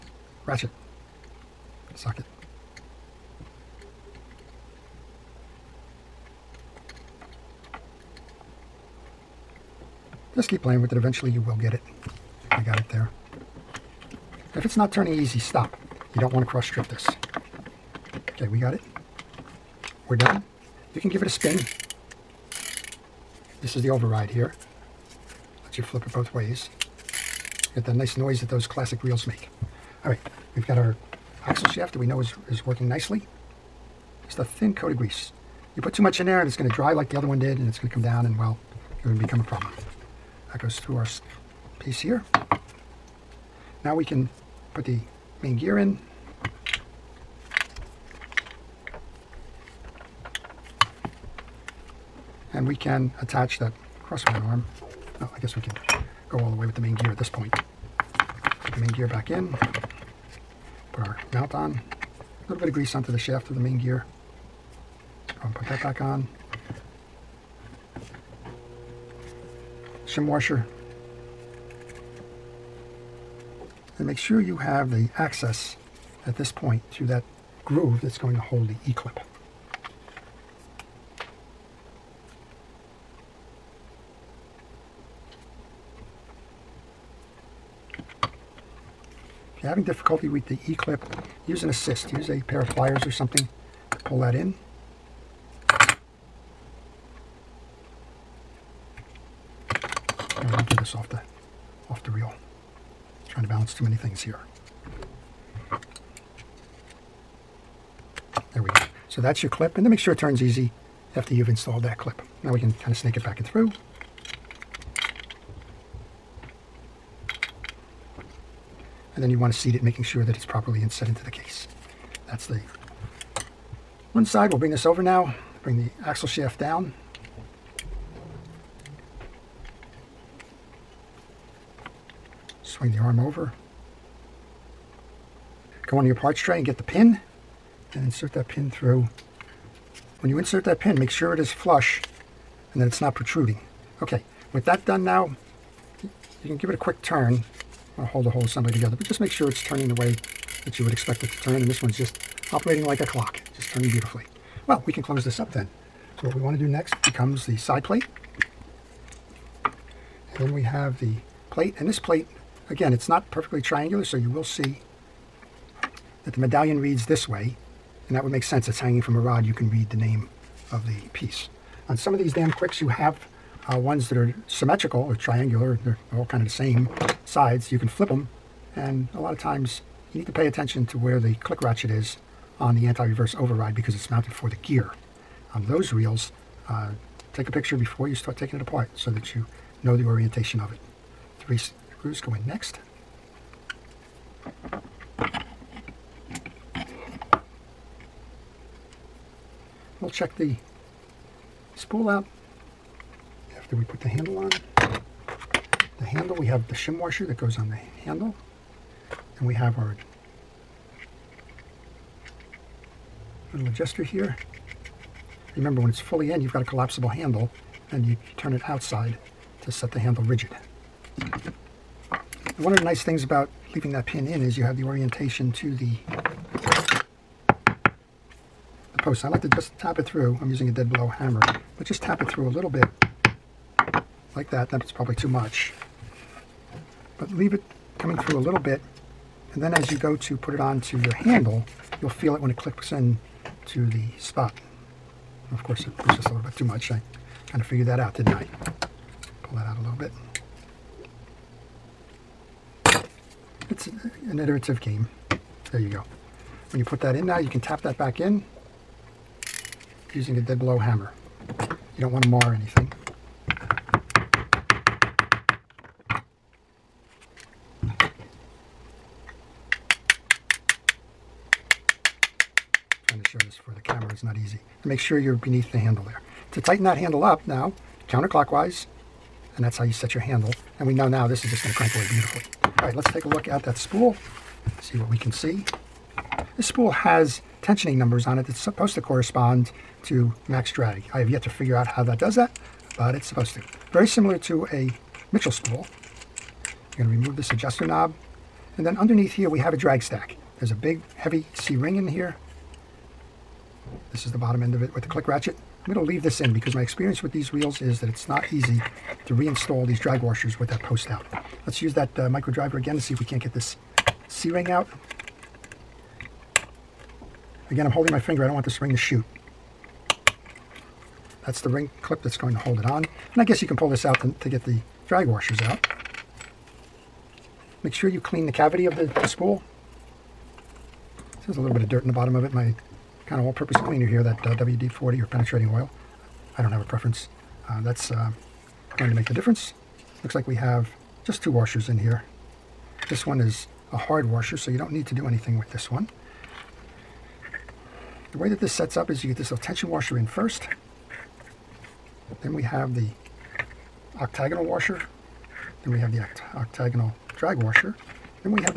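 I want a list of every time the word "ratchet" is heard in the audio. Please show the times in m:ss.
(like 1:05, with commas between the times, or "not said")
0:00, 3:01, 5:05.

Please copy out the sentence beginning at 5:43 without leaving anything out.
This one is a hard washer, so you don't need to do anything with this one.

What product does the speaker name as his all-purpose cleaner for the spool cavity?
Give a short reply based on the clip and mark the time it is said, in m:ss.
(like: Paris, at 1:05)
WD-40, at 5:34.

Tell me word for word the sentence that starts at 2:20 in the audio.
When you insert that pin, make sure it is flush and that it's not protruding.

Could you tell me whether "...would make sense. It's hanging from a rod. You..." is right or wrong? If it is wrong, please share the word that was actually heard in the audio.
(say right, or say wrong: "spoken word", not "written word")
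right.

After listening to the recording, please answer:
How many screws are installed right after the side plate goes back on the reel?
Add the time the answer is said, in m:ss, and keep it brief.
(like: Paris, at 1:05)
3, at 3:11.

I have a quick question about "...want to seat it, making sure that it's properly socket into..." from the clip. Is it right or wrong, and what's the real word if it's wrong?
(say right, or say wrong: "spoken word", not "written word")
wrong: "inset", not "socket".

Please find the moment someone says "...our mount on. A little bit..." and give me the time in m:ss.
1:01.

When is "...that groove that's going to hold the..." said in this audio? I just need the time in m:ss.
1:17.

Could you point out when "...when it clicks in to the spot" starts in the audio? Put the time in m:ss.
4:02.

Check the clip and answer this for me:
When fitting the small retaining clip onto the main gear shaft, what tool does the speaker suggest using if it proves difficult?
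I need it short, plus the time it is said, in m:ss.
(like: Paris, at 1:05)
pair of pliers, at 1:32.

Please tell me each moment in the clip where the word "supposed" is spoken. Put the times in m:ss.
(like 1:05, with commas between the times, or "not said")
4:48, 4:53.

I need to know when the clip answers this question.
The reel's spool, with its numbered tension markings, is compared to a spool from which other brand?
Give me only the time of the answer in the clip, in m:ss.
4:55.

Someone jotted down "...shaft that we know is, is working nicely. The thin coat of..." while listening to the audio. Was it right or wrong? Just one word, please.
right.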